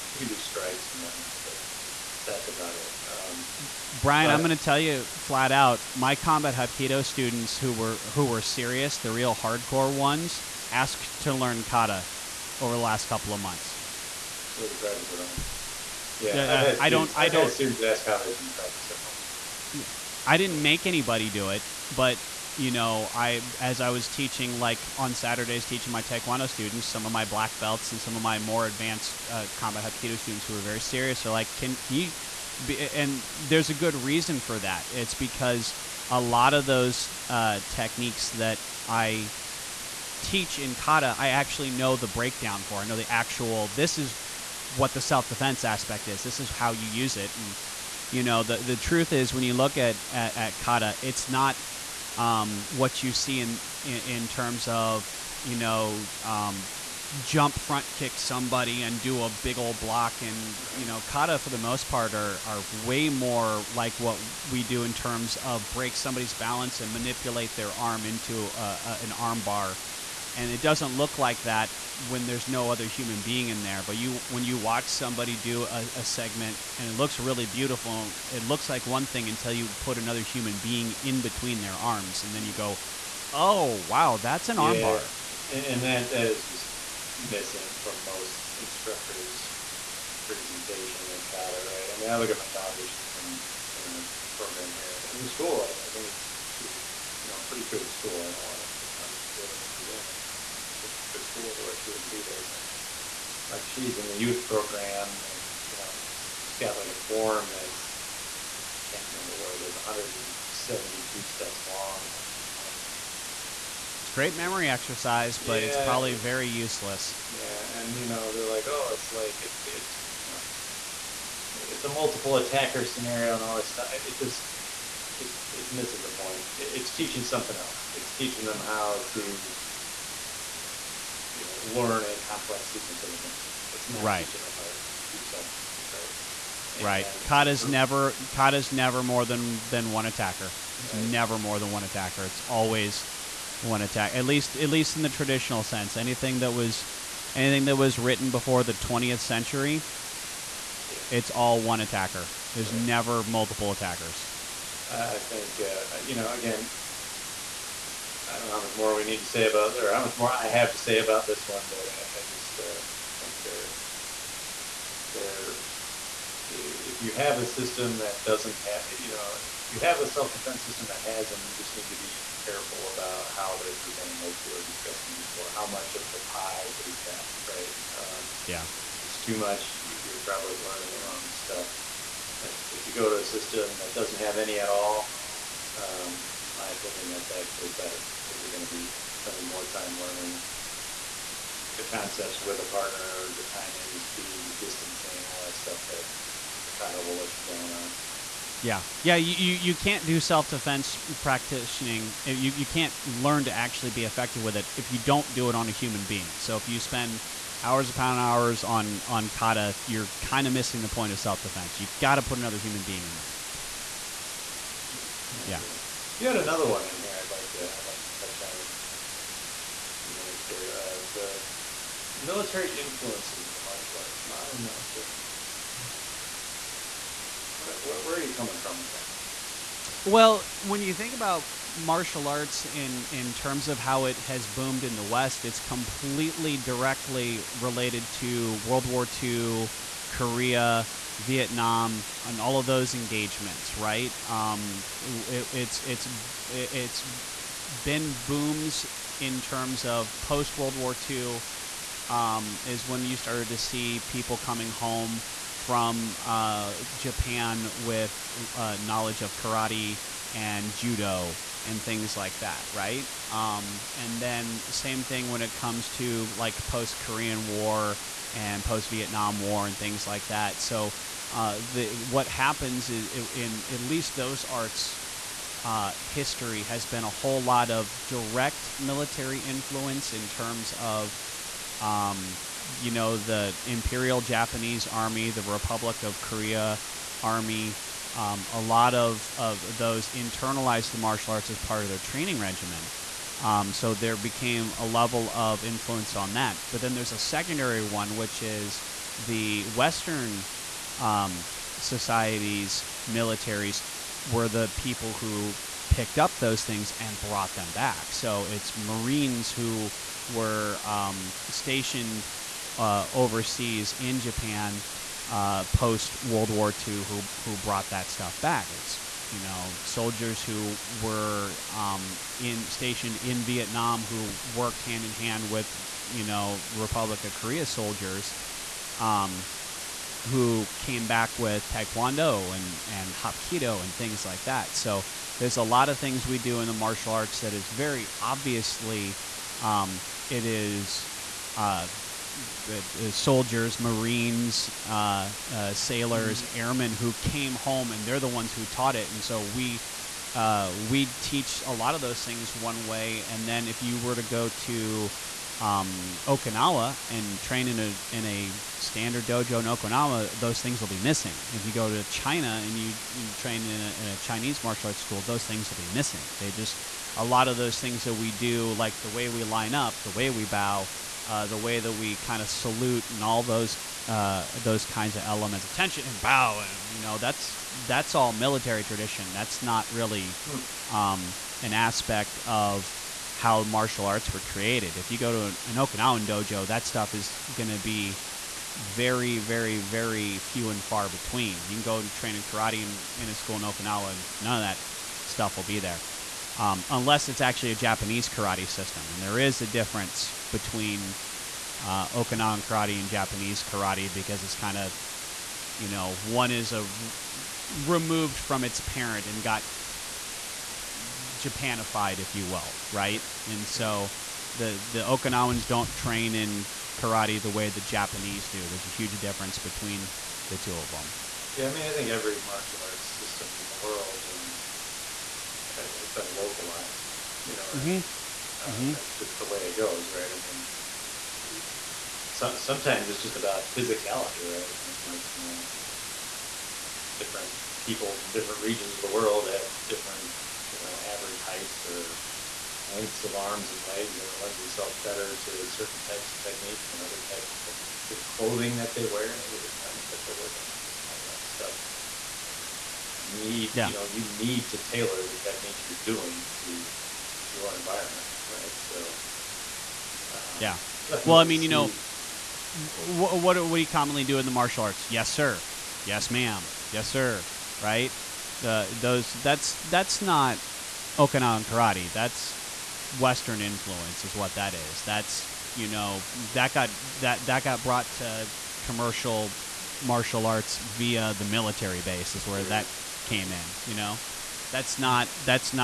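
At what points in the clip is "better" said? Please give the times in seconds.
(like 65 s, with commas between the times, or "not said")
187 s, 445 s.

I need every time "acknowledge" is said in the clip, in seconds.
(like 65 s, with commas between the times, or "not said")
not said.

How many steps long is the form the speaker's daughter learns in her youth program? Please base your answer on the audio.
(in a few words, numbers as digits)
172.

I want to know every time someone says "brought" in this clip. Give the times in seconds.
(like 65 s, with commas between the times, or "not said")
307 s, 317 s, 477 s.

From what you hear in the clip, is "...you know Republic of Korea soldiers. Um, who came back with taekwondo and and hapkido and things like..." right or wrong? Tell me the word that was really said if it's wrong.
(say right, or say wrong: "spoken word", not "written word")
right.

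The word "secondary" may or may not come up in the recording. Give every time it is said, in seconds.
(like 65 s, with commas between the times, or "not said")
297 s.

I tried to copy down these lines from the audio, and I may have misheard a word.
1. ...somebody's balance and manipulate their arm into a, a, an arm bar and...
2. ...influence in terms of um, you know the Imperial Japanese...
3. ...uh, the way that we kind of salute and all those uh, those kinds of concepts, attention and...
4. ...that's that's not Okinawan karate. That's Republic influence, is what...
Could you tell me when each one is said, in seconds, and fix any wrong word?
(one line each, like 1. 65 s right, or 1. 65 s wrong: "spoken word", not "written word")
1. 65 s right
2. 279 s right
3. 371 s wrong: "elements", not "concepts"
4. 469 s wrong: "Western", not "Republic".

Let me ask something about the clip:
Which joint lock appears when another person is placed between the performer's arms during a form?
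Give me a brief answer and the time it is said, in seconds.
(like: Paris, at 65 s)
Armbar, at 84 s.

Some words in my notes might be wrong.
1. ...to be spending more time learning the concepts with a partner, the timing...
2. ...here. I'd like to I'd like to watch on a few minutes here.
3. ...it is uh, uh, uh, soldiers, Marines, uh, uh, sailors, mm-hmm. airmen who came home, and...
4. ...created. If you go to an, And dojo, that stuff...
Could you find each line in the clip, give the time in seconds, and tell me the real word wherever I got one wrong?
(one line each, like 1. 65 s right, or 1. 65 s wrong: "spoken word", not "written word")
1. 188 s right
2. 216 s wrong: "touch", not "watch"
3. 340 s right
4. 384 s wrong: "Okinawan", not "And".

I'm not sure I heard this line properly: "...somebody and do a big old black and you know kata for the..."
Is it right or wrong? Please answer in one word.
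wrong.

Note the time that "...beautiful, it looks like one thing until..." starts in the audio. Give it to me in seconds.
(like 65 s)
77 s.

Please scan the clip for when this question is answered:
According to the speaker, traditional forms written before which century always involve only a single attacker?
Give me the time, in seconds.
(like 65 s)
148 s.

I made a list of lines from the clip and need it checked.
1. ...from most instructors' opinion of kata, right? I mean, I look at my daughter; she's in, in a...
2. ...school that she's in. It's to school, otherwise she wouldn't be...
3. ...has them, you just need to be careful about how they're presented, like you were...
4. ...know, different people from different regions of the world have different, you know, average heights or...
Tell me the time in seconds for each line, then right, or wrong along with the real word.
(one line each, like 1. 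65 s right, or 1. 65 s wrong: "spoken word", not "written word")
1. 87 s wrong: "presentation", not "opinion"
2. 99 s right
3. 171 s right
4. 435 s right.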